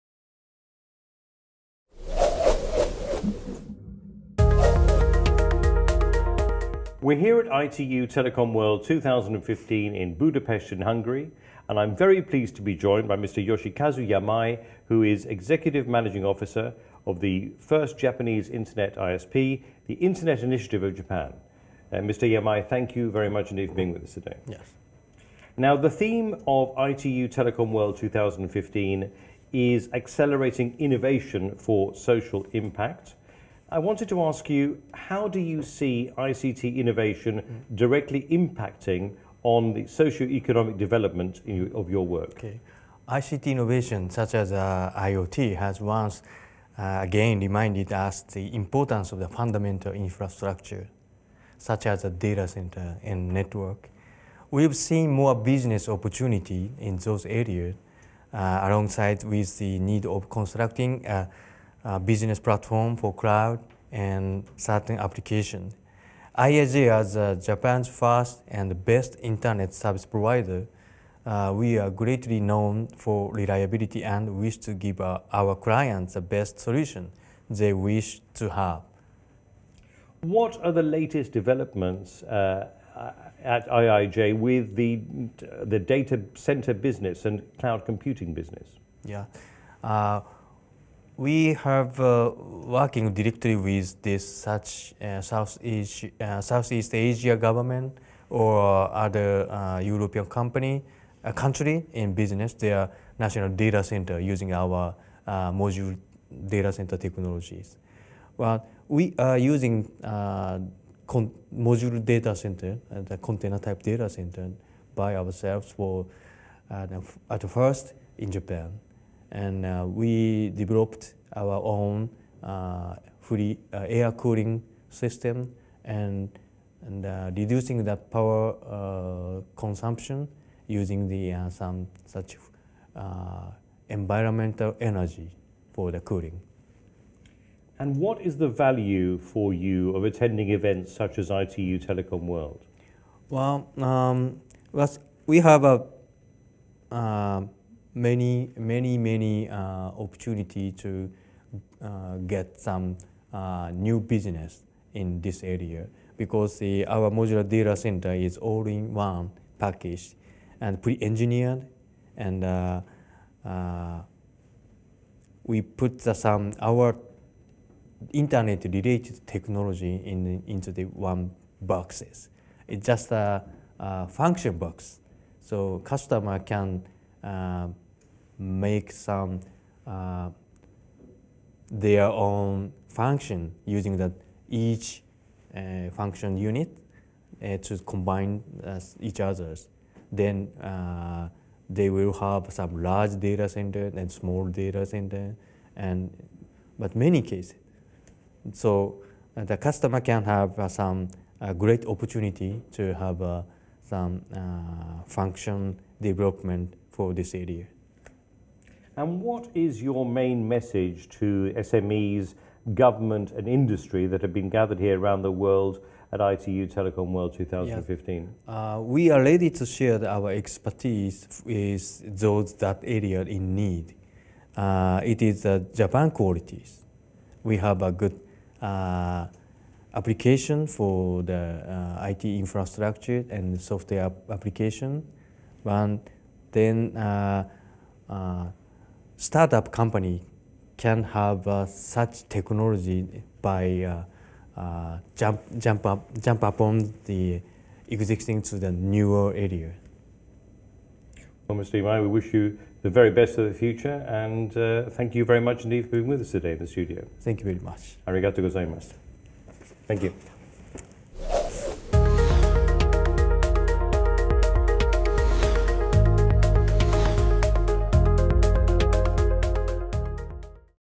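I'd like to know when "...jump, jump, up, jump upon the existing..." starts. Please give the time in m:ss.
4:05.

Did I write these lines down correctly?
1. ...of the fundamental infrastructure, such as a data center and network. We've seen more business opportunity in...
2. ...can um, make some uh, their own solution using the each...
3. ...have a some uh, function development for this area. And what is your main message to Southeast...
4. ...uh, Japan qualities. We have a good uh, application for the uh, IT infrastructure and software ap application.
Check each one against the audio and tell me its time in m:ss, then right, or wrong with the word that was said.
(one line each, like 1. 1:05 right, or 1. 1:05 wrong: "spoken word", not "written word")
1. 0:49 right
2. 2:56 wrong: "function", not "solution"
3. 3:22 wrong: "SMEs", not "Southeast"
4. 3:45 right.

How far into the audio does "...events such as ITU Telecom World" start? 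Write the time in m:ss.
2:20.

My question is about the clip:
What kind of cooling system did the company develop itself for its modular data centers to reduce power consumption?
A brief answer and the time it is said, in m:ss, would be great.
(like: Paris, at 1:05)
Air cooling system, at 2:03.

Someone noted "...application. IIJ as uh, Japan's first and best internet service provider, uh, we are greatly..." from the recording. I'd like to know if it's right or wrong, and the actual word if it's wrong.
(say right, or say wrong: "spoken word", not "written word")
right.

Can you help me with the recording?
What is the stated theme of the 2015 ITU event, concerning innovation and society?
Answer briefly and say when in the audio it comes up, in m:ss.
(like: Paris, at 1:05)
Accelerating innovation for social impact, at 0:29.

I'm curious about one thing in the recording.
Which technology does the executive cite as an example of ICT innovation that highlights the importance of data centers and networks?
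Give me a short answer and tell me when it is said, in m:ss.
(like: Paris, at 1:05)
IoT, at 0:44.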